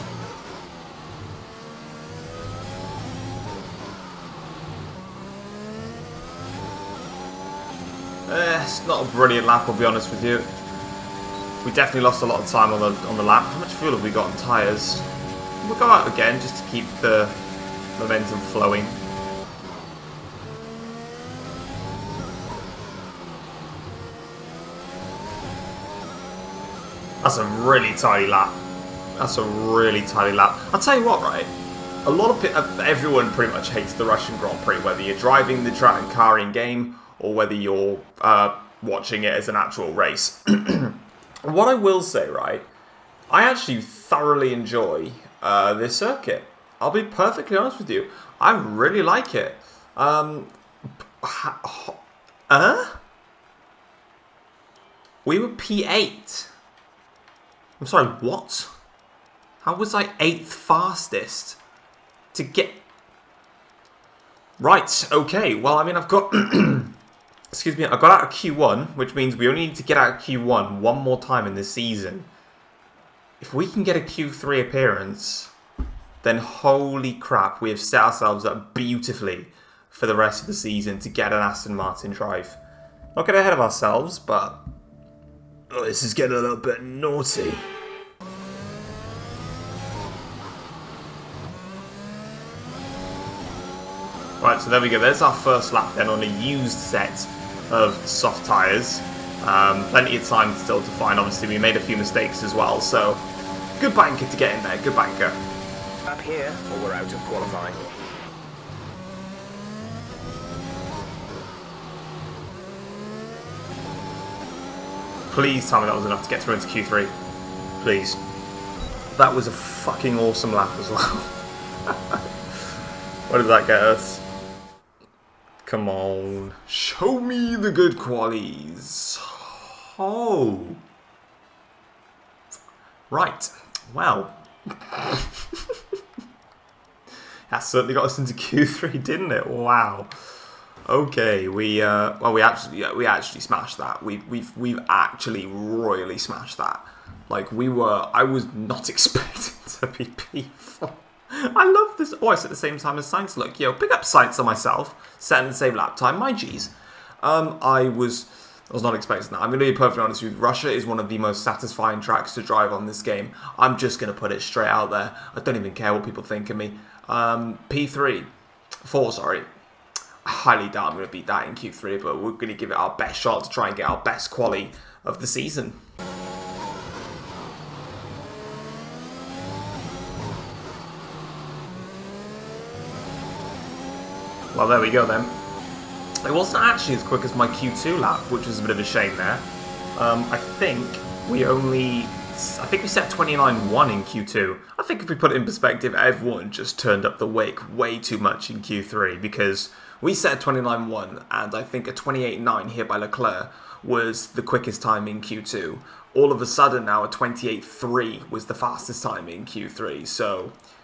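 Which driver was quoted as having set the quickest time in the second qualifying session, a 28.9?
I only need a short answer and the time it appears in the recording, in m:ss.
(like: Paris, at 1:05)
Leclerc, at 3:22.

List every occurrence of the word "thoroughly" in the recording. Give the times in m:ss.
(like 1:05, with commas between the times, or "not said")
0:43.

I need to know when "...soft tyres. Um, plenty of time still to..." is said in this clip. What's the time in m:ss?
1:38.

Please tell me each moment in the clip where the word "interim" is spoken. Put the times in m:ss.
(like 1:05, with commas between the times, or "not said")
not said.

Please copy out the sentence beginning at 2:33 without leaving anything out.
Yo, pick up Sainz on myself.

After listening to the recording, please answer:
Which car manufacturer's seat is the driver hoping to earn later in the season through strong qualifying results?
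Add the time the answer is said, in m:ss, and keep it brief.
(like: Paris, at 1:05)
Aston Martin, at 1:21.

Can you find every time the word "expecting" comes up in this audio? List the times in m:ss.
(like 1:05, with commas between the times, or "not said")
2:28, 2:38.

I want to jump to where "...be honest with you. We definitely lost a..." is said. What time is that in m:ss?
0:09.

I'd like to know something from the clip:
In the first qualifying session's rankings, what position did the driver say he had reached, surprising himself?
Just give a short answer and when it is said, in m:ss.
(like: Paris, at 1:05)
P8, at 0:55.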